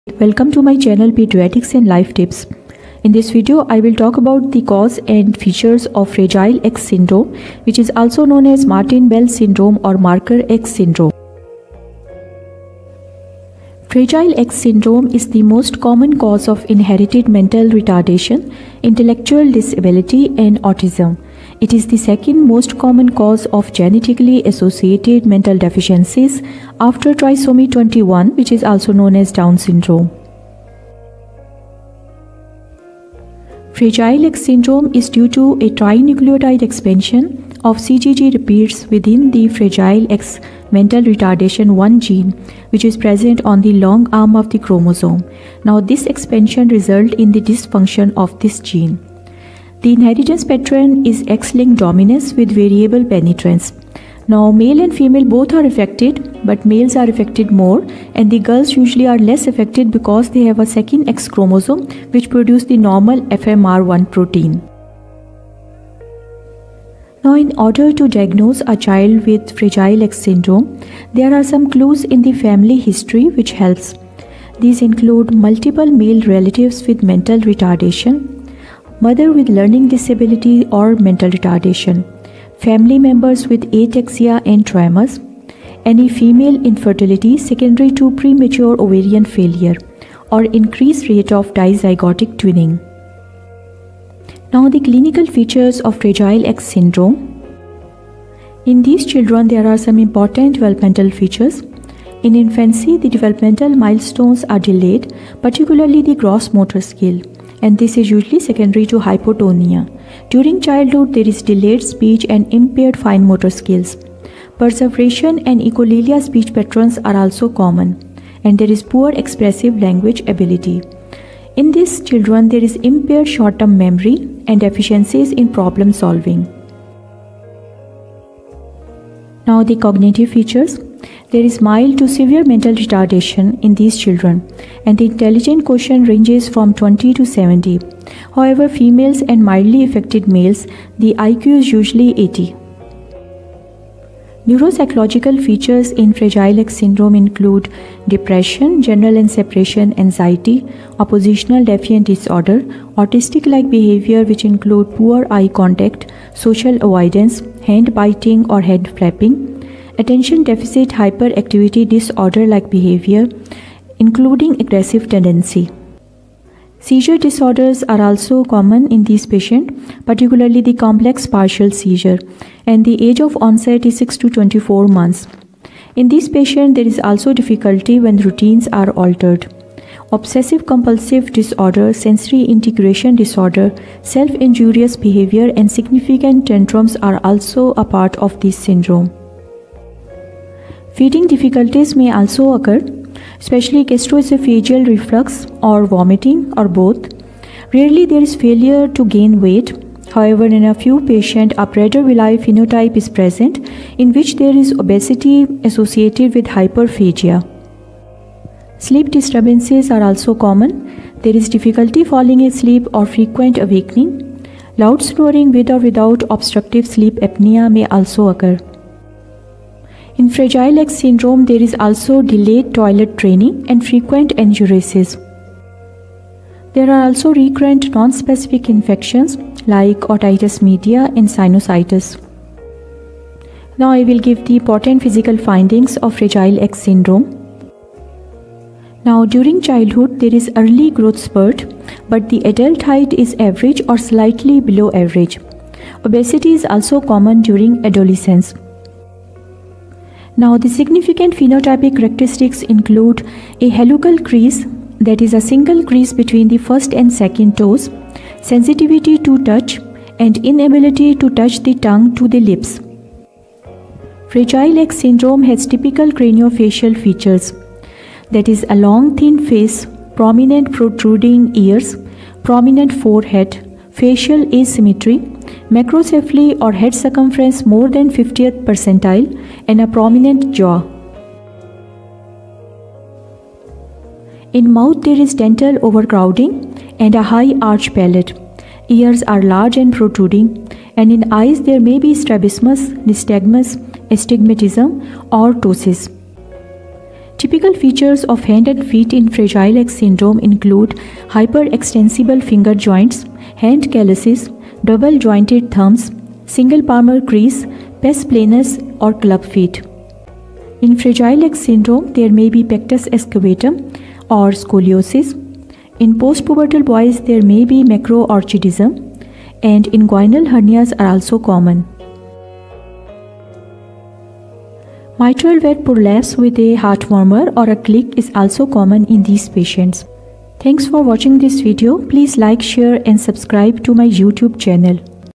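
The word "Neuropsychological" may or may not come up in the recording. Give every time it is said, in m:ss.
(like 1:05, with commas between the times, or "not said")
2:24.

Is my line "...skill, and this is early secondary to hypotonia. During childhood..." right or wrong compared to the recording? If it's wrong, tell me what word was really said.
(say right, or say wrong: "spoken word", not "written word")
wrong: "usually", not "early".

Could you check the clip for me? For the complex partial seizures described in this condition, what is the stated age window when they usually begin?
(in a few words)
6 to 24 months.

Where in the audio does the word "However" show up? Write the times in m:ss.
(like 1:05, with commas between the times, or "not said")
2:18, 3:20.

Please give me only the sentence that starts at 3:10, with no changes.
Feeding difficulties may also occur especially gastroesophageal reflux or vomiting or both.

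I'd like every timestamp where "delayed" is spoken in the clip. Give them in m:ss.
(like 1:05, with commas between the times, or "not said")
1:44, 1:51, 3:42.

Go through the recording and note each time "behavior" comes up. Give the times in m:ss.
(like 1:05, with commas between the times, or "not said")
2:33, 2:42, 3:04.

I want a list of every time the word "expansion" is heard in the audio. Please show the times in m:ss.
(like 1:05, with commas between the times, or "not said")
0:36, 0:46.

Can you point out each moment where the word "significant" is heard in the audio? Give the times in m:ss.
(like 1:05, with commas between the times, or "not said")
3:05, 4:10.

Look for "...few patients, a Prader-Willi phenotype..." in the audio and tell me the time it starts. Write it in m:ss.
3:20.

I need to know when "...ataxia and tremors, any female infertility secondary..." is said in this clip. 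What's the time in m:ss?
1:23.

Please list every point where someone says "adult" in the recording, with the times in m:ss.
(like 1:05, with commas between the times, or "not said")
4:02.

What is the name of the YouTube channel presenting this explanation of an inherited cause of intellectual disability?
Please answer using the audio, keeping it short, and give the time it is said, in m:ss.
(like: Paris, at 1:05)
Pediatrics and Life Tips, at 0:01.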